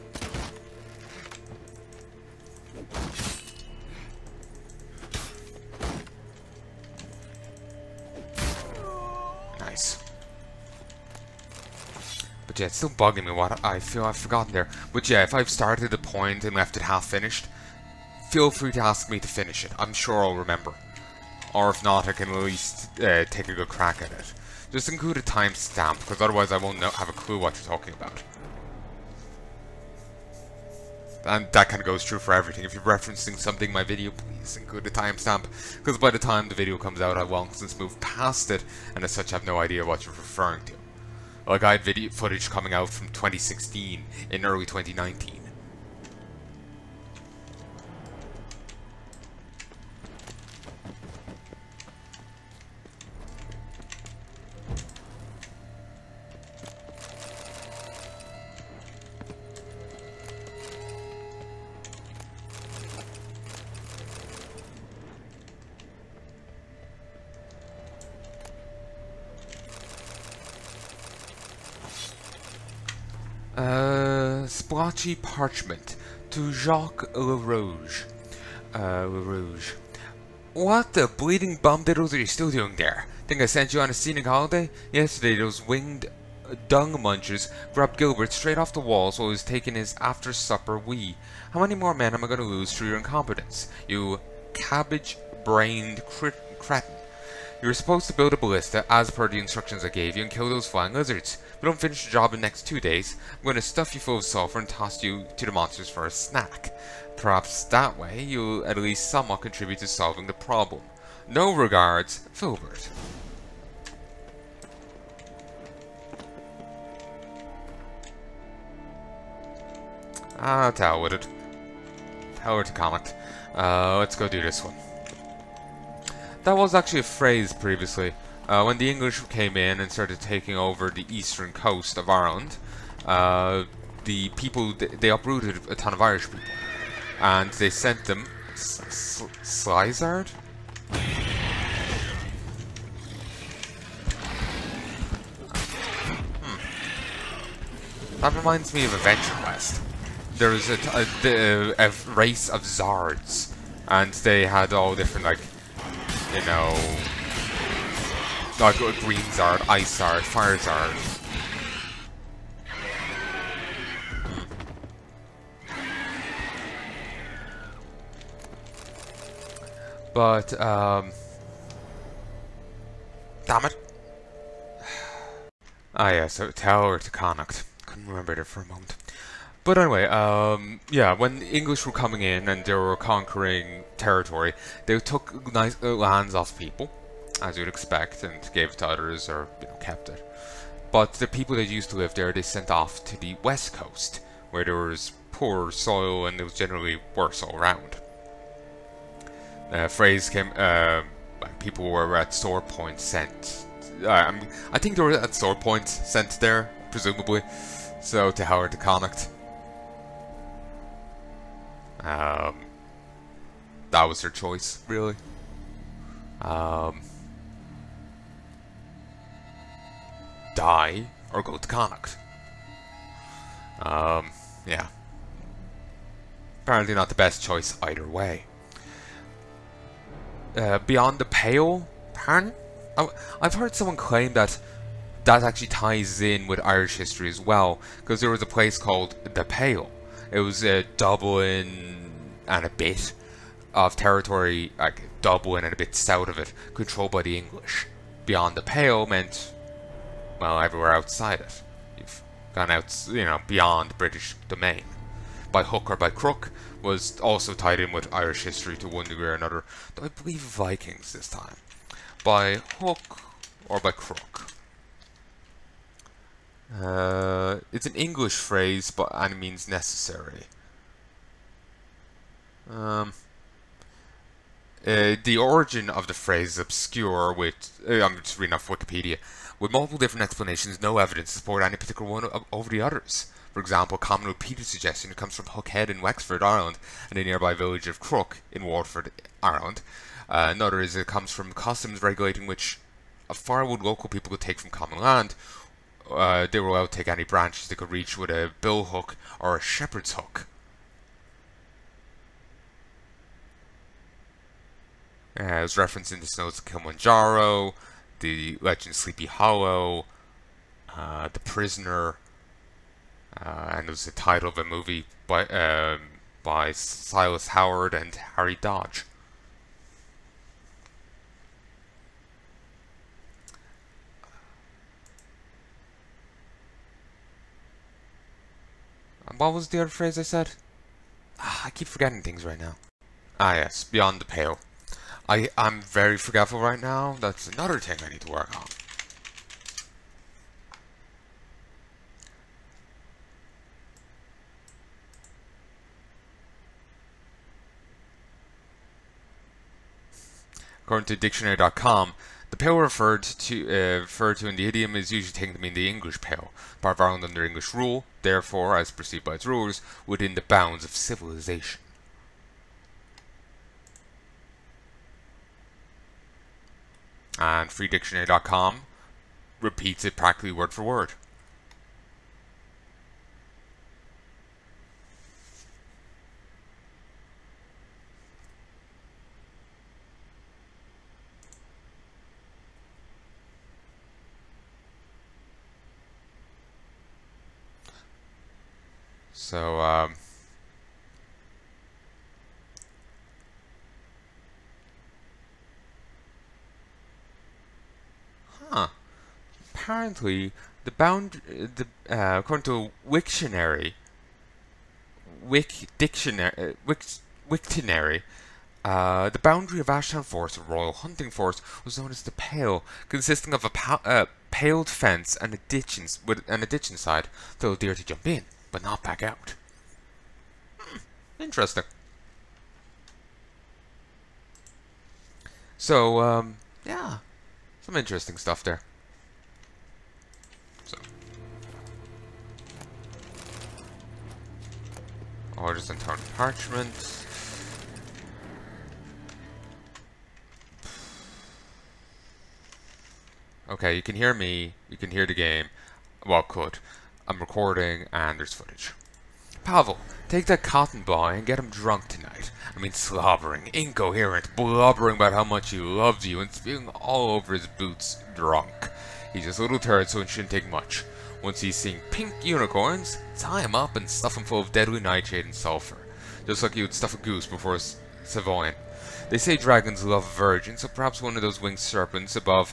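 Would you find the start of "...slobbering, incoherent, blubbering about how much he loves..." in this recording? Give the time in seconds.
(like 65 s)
452 s.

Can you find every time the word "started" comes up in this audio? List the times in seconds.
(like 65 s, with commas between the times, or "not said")
15 s, 129 s.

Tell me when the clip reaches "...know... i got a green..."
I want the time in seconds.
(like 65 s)
156 s.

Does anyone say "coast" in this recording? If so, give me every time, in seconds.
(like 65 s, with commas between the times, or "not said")
131 s, 193 s.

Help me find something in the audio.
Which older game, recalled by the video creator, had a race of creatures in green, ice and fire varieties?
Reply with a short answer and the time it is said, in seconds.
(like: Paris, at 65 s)
Adventure Quest, at 148 s.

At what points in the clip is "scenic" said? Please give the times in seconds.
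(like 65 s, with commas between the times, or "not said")
83 s.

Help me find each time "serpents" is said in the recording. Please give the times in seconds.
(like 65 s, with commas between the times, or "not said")
471 s.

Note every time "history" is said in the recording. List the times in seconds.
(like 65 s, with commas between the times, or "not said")
236 s, 258 s.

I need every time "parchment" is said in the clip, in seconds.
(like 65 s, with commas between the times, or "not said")
75 s, 436 s.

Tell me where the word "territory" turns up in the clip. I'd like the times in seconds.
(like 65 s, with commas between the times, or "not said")
183 s, 243 s.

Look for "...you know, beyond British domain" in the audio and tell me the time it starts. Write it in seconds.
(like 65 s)
253 s.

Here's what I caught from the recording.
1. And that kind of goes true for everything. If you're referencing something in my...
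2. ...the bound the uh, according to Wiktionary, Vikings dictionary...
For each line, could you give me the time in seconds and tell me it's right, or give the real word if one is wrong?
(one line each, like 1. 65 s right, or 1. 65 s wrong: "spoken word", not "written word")
1. 31 s right
2. 400 s wrong: "Wik", not "Vikings".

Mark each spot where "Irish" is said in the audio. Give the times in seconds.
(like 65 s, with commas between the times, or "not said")
135 s, 236 s, 258 s.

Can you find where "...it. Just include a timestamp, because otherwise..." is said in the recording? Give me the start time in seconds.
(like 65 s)
24 s.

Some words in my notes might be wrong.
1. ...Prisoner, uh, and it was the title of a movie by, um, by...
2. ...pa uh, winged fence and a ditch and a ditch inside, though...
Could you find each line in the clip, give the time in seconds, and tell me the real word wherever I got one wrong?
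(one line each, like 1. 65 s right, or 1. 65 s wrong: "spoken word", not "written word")
1. 311 s right
2. 413 s wrong: "paled", not "winged".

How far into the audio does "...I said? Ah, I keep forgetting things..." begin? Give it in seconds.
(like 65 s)
330 s.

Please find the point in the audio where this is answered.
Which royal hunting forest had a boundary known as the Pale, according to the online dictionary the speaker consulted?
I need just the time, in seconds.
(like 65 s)
409 s.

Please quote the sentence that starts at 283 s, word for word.
For example, a common repeated suggestion comes from Hookhead in Wexford, Ireland, and the nearby village of Crook in Waterford, Ireland.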